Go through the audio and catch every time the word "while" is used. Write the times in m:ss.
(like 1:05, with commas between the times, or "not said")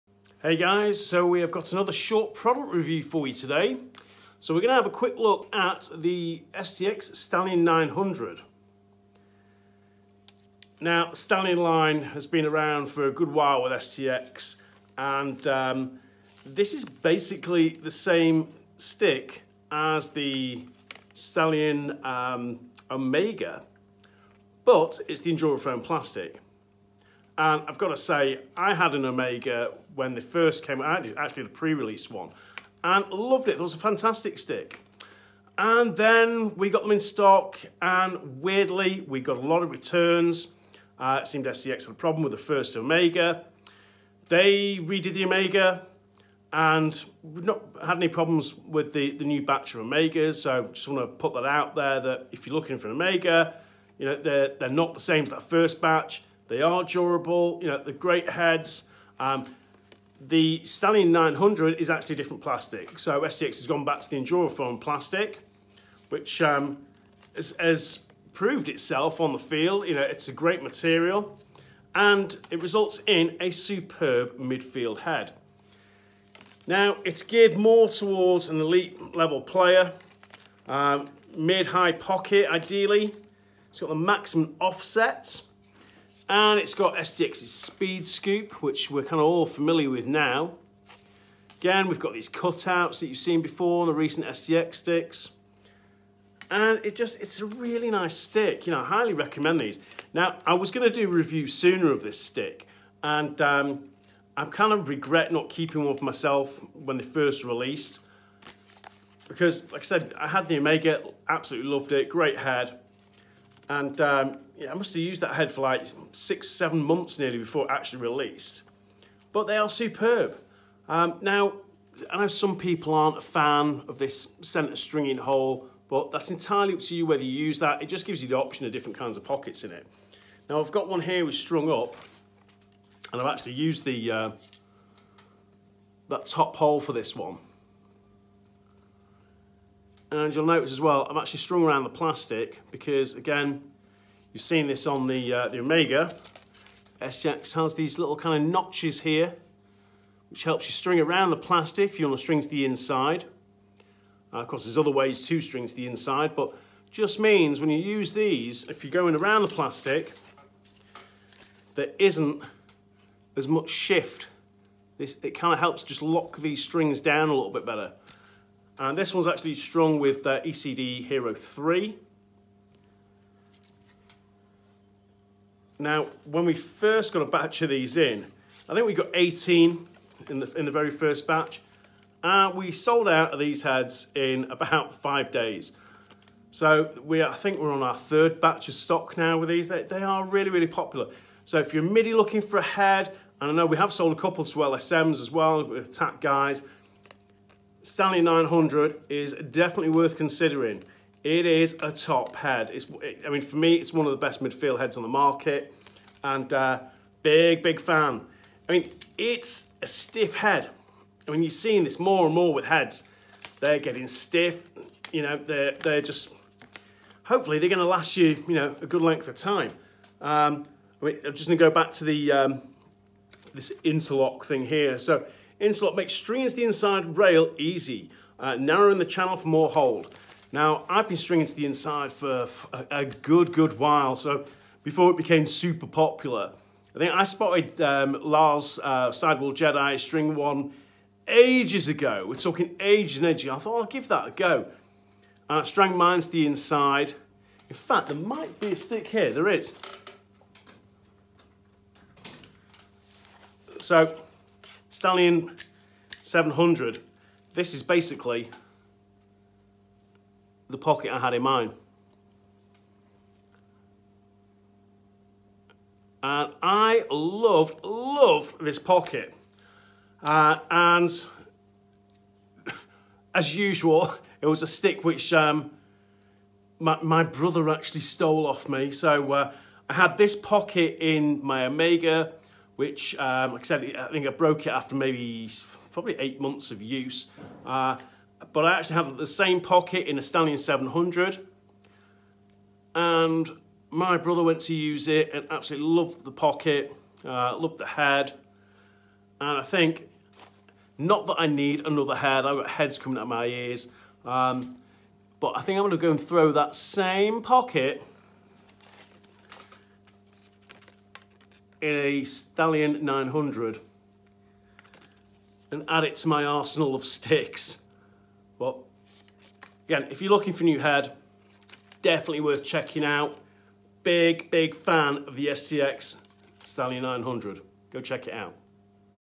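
0:13, 3:53.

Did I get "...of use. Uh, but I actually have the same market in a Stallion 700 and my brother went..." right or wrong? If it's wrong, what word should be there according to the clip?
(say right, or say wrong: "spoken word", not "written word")
wrong: "pocket", not "market".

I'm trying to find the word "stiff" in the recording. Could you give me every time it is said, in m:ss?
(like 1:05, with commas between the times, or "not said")
3:29, 3:34.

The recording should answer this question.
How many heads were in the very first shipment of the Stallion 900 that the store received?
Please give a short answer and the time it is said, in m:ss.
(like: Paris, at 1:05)
18, at 2:59.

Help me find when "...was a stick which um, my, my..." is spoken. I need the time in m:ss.
4:34.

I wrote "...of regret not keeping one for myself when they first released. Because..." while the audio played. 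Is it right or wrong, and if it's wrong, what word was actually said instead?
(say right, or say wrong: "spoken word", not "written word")
right.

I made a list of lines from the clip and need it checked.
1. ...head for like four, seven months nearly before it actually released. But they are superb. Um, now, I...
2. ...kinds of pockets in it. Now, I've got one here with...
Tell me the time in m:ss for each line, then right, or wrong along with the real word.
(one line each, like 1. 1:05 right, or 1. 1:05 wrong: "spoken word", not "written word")
1. 1:55 wrong: "six", not "four"
2. 2:08 right.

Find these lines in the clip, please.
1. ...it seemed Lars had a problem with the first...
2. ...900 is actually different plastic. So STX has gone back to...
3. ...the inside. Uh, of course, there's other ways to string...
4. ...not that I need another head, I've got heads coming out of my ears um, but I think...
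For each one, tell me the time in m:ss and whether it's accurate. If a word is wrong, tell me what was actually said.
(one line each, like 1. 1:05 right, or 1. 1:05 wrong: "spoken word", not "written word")
1. 0:41 wrong: "STX", not "Lars"
2. 1:01 right
3. 2:32 right
4. 5:00 right.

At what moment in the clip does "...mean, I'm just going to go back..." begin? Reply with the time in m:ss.
3:41.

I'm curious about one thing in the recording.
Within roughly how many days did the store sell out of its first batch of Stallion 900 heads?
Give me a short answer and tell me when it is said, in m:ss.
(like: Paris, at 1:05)
5 days, at 3:04.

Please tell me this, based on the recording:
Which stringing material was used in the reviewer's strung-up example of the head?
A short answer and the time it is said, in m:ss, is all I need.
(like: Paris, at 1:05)
ECD Hero 3, at 2:50.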